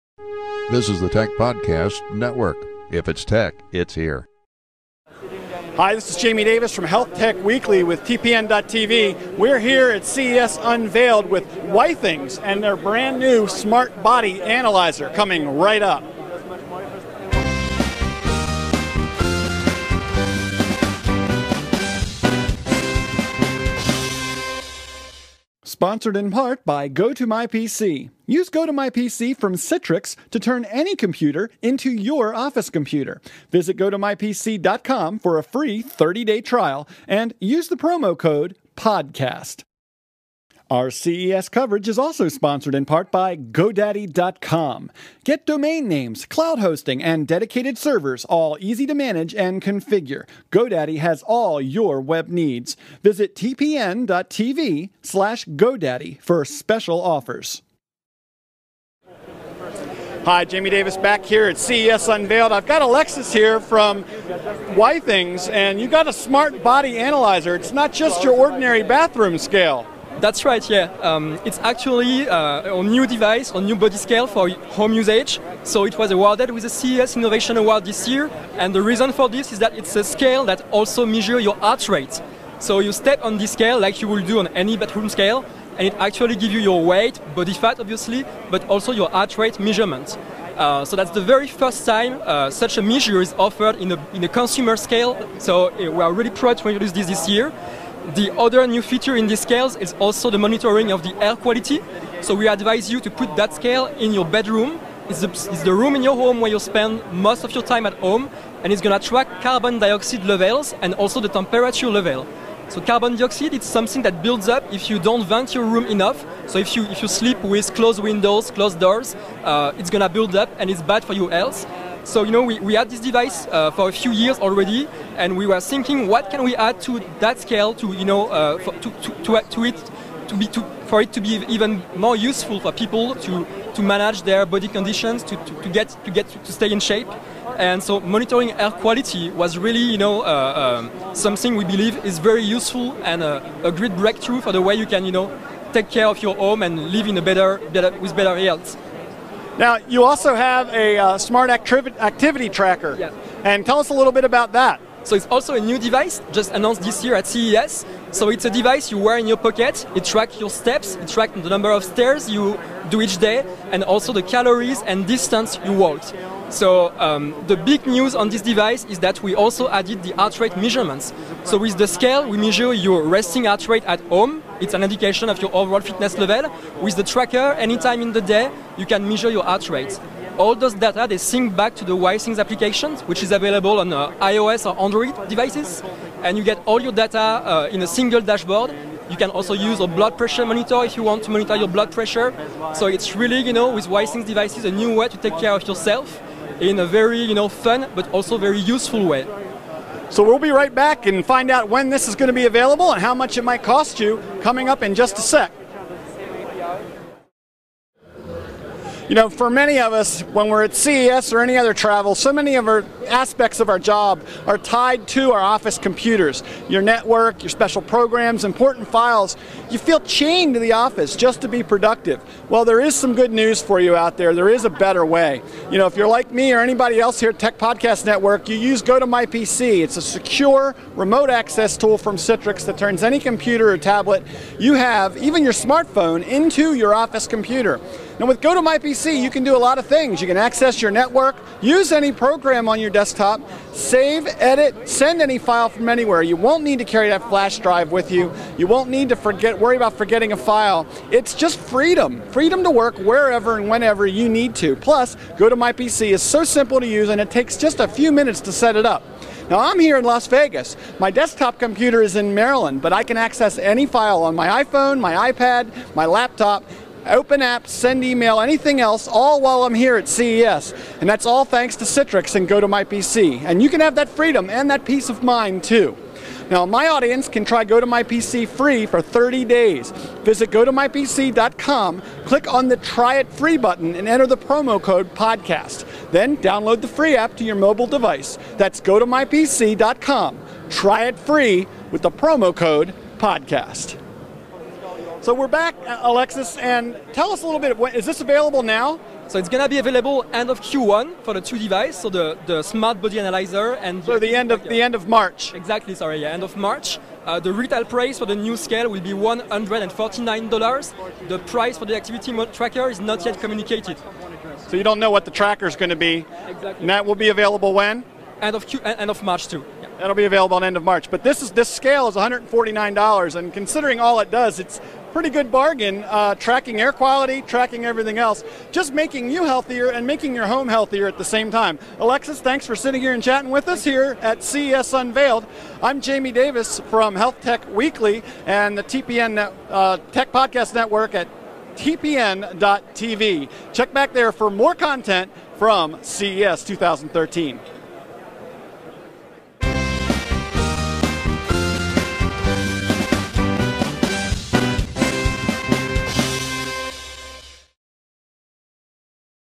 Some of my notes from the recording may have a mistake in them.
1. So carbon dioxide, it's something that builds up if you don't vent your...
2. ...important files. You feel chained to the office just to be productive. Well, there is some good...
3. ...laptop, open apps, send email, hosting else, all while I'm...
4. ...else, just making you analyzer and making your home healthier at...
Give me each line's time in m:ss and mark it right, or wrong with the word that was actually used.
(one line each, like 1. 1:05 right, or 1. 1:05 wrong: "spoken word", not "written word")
1. 1:52 right
2. 3:38 right
3. 4:26 wrong: "anything", not "hosting"
4. 5:28 wrong: "healthier", not "analyzer".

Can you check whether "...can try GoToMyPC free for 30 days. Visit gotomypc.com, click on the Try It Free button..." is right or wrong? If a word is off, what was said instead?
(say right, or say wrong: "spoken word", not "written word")
right.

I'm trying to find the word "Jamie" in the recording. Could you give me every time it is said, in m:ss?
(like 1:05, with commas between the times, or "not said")
0:06, 1:00, 5:36.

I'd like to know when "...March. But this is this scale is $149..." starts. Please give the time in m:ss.
5:20.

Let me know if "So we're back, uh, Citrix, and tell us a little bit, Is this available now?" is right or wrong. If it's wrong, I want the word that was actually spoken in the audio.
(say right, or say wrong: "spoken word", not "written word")
wrong: "Alexis", not "Citrix".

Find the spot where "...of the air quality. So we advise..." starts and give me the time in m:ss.
1:40.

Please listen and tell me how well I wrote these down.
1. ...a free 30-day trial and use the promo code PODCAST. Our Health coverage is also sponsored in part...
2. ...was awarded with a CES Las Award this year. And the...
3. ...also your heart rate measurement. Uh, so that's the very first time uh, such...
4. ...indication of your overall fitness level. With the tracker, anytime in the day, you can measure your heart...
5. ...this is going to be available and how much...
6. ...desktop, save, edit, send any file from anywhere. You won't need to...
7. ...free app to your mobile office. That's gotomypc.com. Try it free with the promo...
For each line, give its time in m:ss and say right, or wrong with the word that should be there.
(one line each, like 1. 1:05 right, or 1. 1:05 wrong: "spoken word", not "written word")
1. 0:35 wrong: "CES", not "Health"
2. 1:15 wrong: "Innovation", not "Las"
3. 1:28 right
4. 2:54 right
5. 3:21 right
6. 4:03 right
7. 4:46 wrong: "device", not "office".